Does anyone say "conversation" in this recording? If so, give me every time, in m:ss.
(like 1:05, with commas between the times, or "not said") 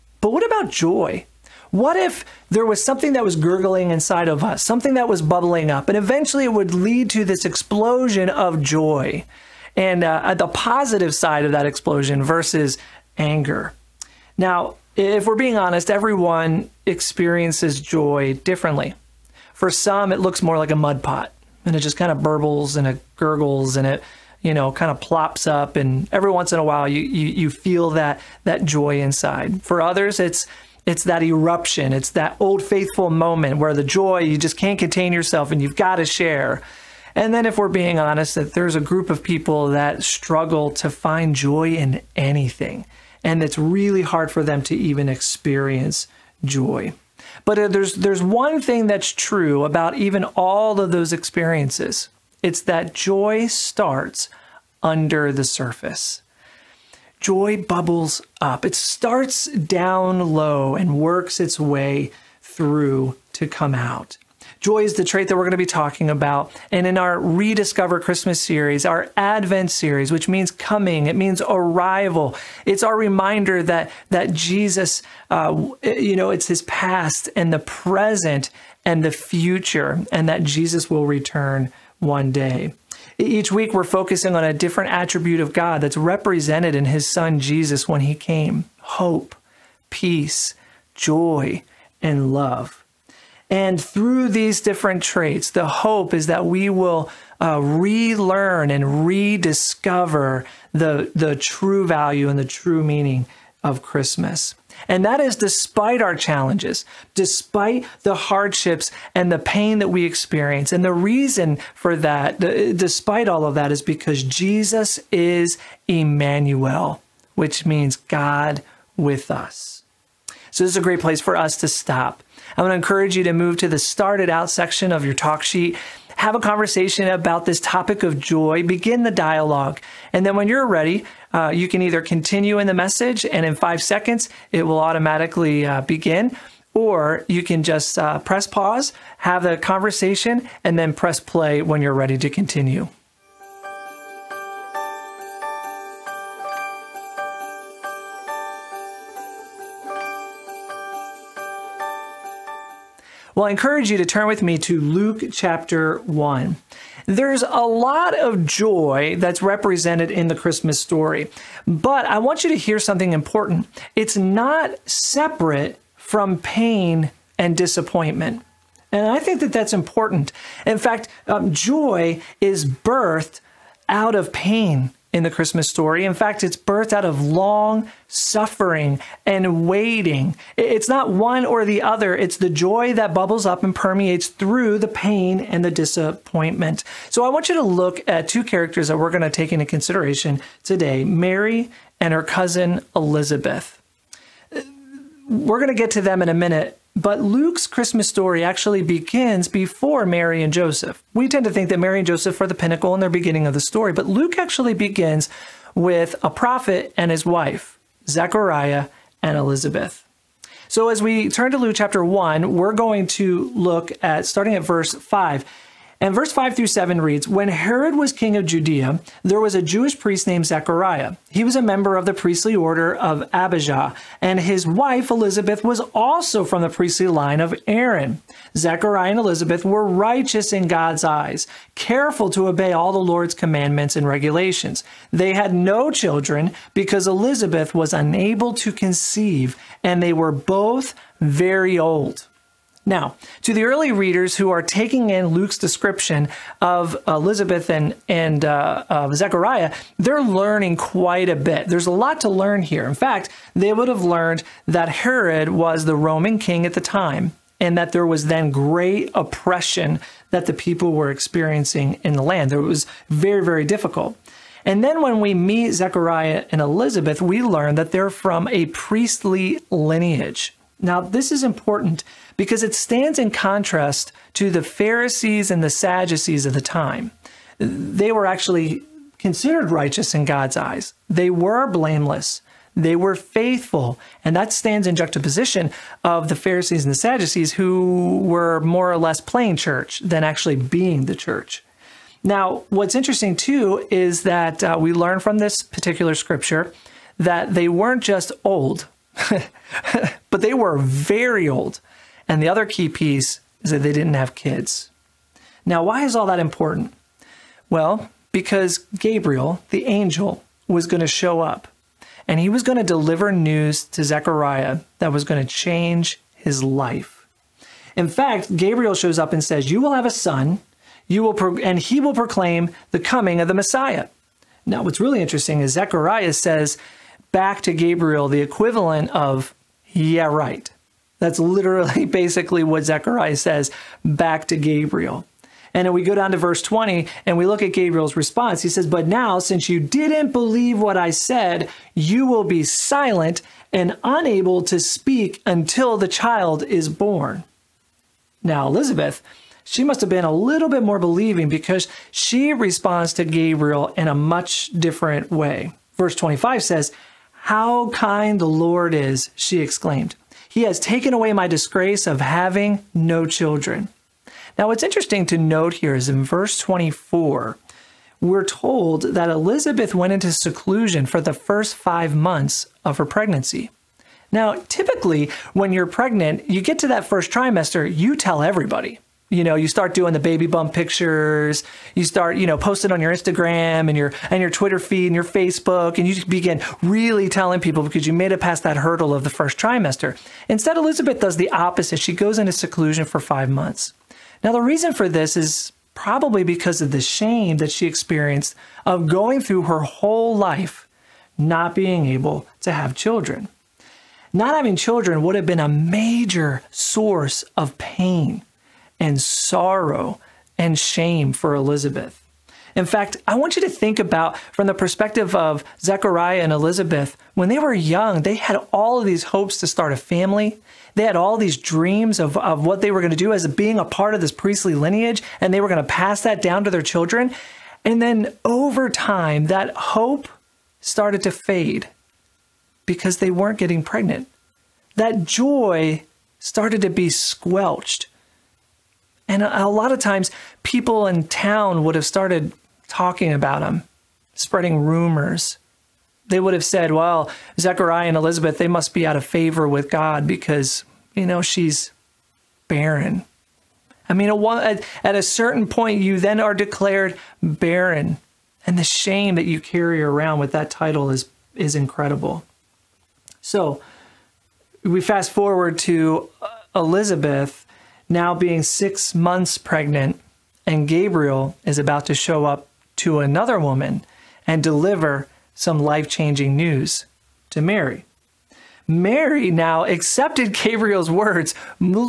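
2:06, 2:19.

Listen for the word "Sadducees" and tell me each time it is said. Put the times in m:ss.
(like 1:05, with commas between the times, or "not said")
4:35, 4:46.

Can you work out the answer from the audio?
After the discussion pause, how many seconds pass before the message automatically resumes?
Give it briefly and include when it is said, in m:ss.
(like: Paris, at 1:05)
5, at 2:13.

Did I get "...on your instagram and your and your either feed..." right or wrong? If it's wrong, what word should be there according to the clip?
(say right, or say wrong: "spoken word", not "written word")
wrong: "twitter", not "either".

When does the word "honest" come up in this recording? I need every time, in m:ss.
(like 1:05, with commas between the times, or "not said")
0:15, 0:37.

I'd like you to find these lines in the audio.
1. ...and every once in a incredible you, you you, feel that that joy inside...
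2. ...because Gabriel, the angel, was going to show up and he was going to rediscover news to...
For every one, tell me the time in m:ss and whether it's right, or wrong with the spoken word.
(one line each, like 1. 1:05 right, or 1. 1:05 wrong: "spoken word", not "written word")
1. 0:25 wrong: "while", not "incredible"
2. 5:08 wrong: "deliver", not "rediscover".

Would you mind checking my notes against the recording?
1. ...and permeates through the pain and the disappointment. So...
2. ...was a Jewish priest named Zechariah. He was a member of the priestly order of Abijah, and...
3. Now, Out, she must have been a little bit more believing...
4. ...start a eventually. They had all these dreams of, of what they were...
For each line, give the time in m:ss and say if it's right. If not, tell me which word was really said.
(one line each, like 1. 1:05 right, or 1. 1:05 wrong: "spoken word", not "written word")
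1. 3:03 right
2. 3:39 right
3. 5:48 wrong: "Elizabeth", not "Out"
4. 6:59 wrong: "family", not "eventually".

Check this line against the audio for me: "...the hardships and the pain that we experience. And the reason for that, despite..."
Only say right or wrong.
right.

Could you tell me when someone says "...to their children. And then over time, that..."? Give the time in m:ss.
7:06.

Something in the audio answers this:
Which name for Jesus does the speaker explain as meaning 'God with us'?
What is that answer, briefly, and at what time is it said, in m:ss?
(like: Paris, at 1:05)
Emmanuel, at 1:55.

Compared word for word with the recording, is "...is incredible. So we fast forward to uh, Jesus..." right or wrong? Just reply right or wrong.
wrong.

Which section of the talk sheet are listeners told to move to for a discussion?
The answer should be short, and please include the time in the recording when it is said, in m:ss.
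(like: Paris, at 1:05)
Start It Out, at 2:03.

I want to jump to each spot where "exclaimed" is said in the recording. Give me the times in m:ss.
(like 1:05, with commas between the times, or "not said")
5:59.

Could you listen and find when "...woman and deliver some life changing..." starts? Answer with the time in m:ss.
7:53.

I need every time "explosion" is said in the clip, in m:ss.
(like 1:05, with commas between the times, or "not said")
0:07, 0:11.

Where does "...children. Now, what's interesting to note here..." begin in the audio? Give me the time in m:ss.
6:03.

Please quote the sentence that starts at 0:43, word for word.
And it's really hard for them to even experience joy.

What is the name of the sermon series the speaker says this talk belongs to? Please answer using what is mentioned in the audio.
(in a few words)
Rediscover Christmas.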